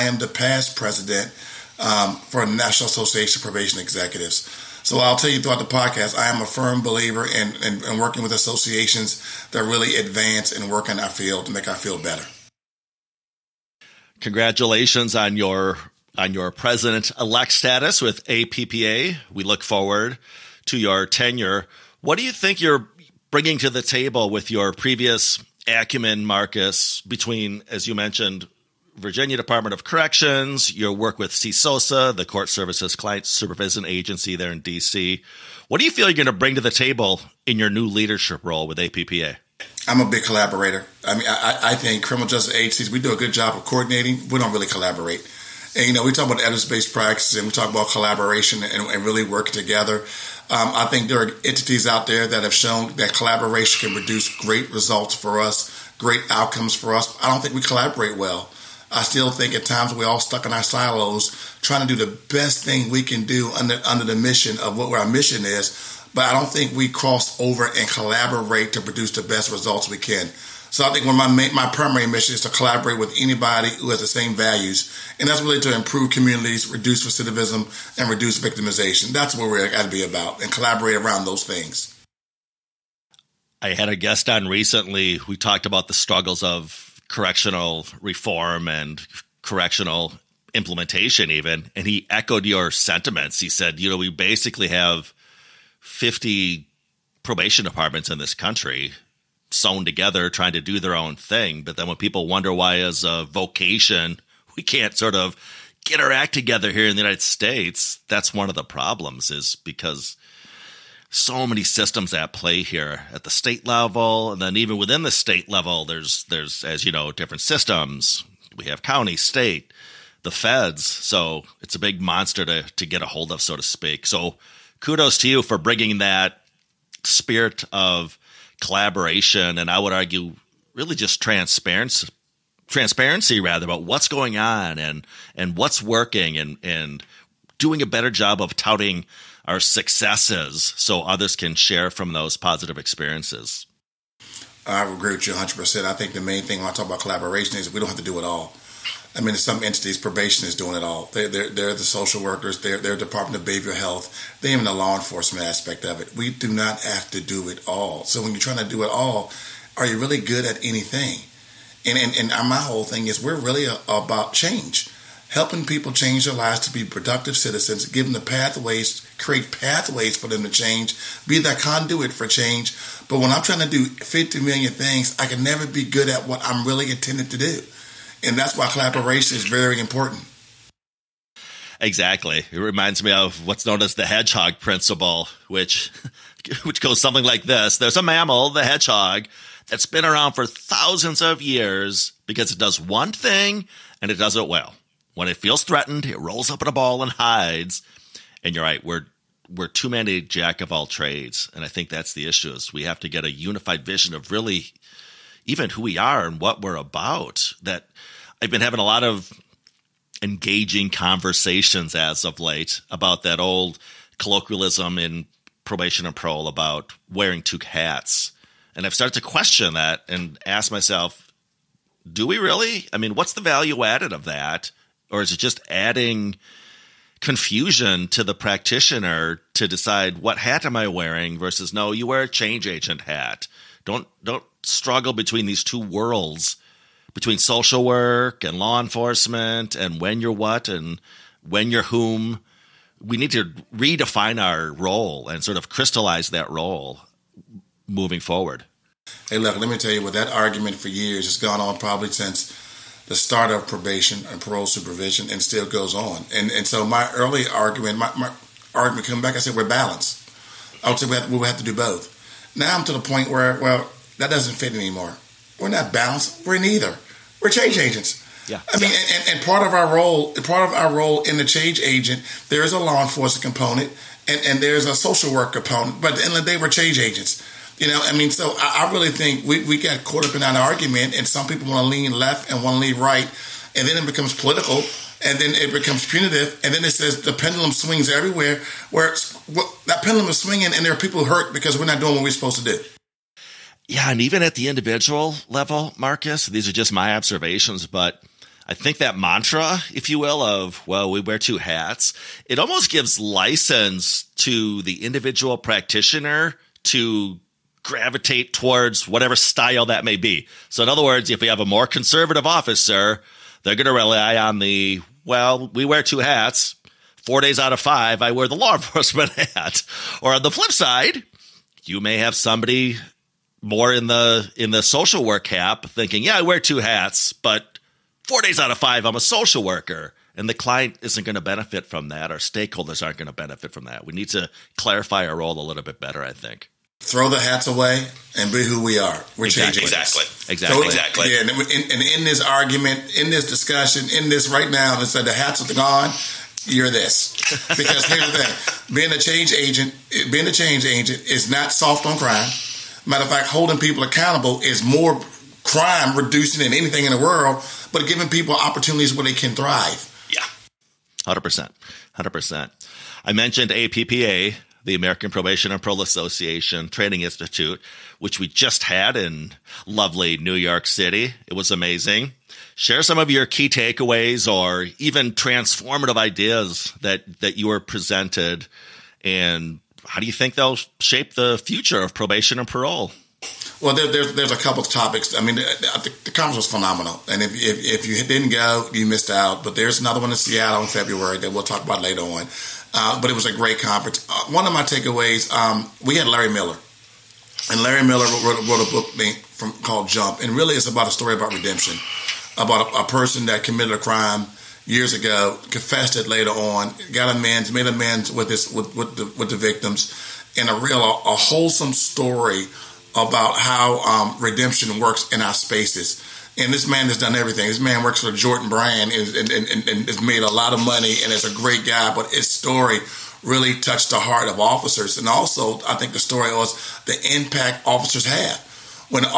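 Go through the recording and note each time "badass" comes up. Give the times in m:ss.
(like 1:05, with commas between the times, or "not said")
not said.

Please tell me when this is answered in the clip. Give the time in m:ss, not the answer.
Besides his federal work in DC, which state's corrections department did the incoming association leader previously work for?
0:28.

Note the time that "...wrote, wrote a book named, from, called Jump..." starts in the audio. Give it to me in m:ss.
6:38.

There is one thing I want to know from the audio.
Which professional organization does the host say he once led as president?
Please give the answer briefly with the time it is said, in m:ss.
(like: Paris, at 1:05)
National Association of Probation Executives, at 0:02.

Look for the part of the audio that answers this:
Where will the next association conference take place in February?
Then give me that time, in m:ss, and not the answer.
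6:30.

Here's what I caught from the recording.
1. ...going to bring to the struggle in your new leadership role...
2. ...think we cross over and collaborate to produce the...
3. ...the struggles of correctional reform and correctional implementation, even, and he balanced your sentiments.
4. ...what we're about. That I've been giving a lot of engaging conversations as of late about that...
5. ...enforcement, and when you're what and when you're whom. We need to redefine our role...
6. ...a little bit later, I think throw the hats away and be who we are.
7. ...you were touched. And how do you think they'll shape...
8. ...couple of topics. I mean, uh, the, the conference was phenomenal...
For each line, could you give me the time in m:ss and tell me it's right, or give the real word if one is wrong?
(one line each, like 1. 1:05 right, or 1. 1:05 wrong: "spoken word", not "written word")
1. 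0:36 wrong: "table", not "struggle"
2. 1:06 right
3. 1:25 wrong: "echoed", not "balanced"
4. 3:26 wrong: "having", not "giving"
5. 3:58 right
6. 5:35 wrong: "better", not "later"
7. 6:17 wrong: "presented", not "touched"
8. 6:24 right.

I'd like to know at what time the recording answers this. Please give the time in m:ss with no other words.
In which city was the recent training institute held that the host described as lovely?
6:10.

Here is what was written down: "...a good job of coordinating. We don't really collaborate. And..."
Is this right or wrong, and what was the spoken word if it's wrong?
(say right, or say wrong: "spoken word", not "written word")
right.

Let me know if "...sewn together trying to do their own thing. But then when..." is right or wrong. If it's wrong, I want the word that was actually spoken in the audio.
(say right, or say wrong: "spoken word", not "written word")
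right.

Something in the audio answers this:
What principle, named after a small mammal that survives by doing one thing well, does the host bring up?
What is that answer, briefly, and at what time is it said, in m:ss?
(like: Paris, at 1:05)
hedgehog principle, at 3:04.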